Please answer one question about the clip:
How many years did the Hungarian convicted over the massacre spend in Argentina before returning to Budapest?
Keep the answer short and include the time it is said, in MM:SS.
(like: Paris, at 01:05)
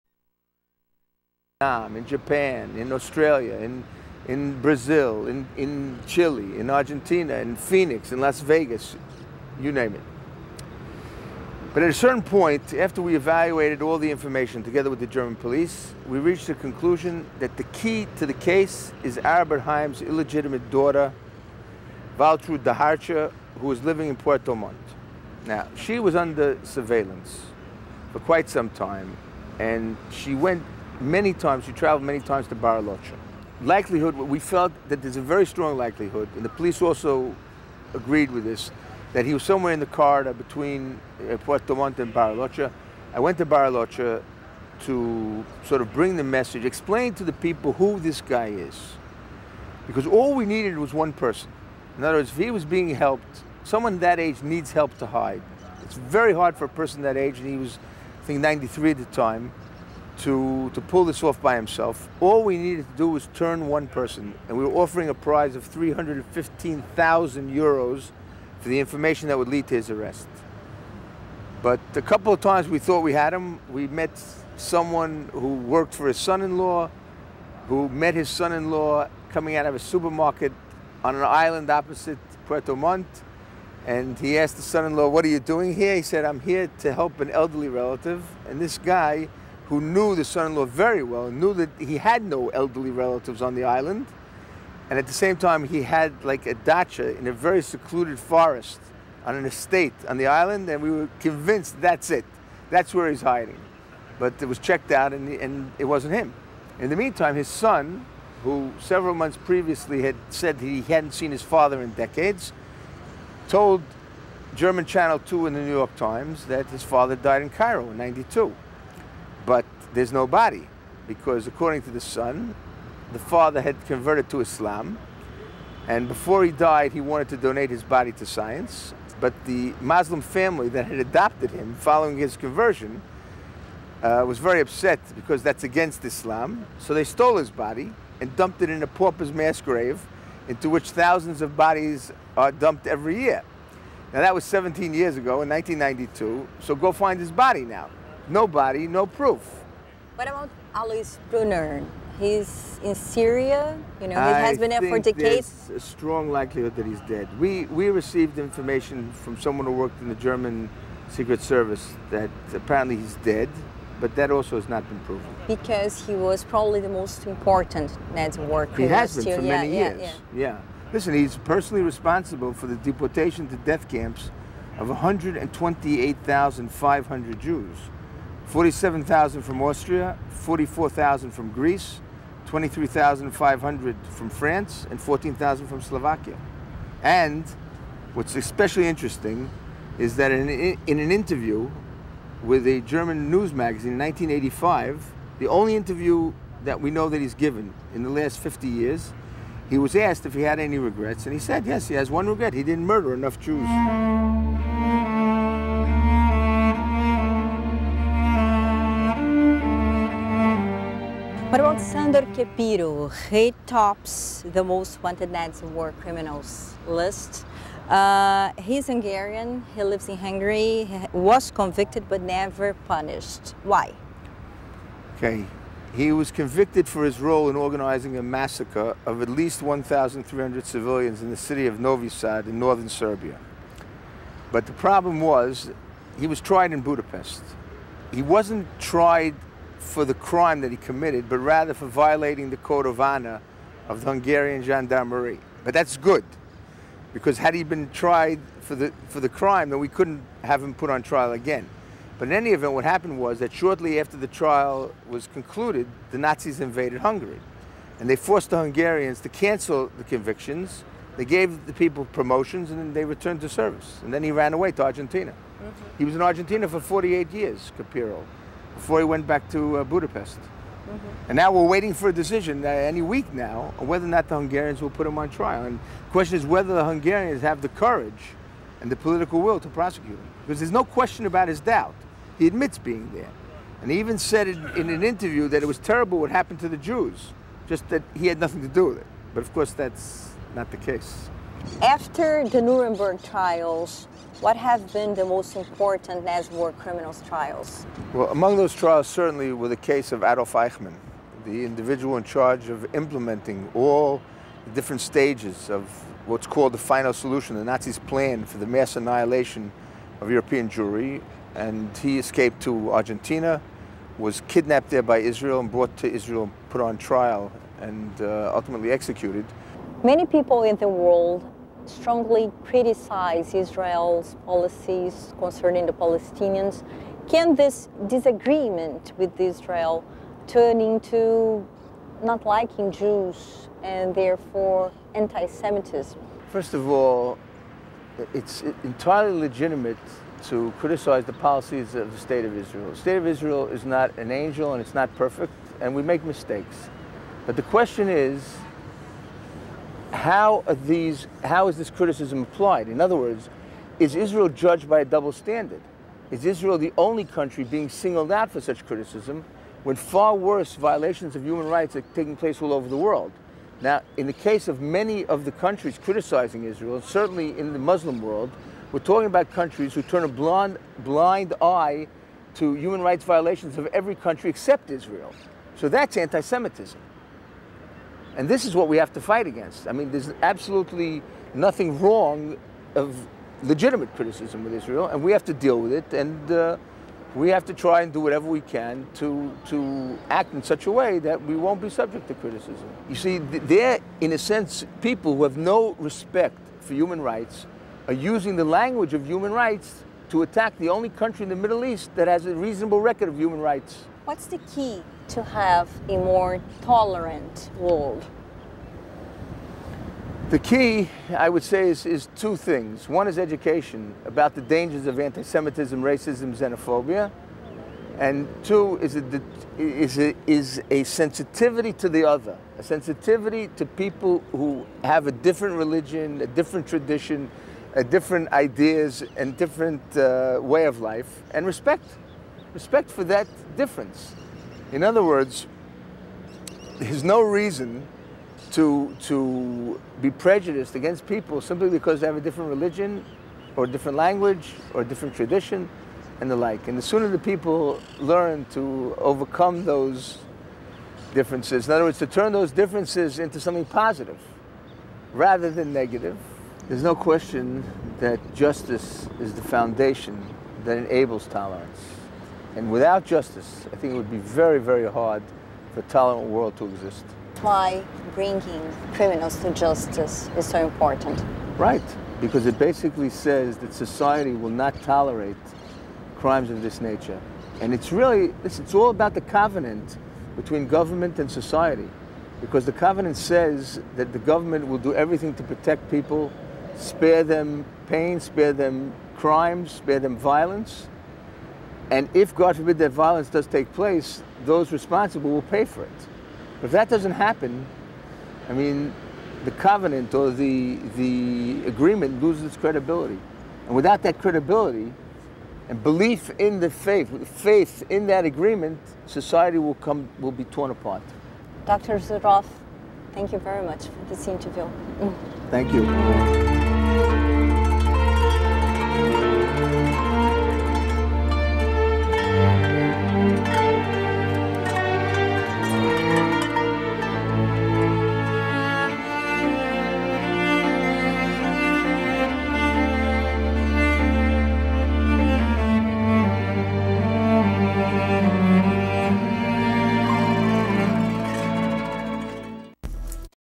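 48 years, at 04:26.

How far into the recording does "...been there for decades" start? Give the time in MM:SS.
02:34.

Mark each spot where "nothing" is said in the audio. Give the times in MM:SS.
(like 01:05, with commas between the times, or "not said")
04:48, 06:21.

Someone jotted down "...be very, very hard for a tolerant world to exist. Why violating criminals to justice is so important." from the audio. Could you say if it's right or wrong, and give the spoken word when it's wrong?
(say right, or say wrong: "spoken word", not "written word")
wrong: "bringing", not "violating".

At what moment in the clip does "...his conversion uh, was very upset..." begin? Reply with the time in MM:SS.
02:12.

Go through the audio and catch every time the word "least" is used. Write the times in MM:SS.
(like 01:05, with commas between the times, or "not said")
03:49.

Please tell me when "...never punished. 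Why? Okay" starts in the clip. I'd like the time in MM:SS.
03:42.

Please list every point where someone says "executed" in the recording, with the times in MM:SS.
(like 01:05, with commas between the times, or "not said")
05:18.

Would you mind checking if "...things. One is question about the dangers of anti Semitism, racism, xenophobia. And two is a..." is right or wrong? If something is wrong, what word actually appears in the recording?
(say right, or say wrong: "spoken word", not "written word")
wrong: "education", not "question".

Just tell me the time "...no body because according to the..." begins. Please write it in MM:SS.
02:00.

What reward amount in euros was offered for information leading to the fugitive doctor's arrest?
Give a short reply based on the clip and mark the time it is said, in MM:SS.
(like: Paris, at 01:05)
315,000 euros, at 01:05.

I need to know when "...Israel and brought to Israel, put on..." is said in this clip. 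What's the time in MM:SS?
05:15.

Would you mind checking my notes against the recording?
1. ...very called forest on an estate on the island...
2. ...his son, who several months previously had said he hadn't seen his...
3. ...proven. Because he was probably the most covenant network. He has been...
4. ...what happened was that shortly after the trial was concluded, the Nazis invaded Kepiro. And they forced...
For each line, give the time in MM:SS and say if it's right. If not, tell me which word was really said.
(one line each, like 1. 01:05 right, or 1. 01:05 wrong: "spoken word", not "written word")
1. 01:37 wrong: "secluded", not "called"
2. 01:47 right
3. 02:44 wrong: "important", not "covenant"
4. 04:12 wrong: "Hungary", not "Kepiro".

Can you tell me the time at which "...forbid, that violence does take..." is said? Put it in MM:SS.
08:12.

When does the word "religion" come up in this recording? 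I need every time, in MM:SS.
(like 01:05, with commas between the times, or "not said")
07:05, 07:22.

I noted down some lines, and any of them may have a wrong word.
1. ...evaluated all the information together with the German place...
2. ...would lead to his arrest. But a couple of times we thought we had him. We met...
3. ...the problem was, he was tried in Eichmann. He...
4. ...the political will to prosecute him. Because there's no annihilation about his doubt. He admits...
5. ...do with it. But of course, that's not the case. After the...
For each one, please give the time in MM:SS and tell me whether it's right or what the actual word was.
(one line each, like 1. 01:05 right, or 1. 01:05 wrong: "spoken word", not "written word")
1. 00:13 wrong: "police", not "place"
2. 01:09 right
3. 03:54 wrong: "Budapest", not "Eichmann"
4. 04:38 wrong: "question", not "annihilation"
5. 04:48 right.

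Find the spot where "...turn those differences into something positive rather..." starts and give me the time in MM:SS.
07:32.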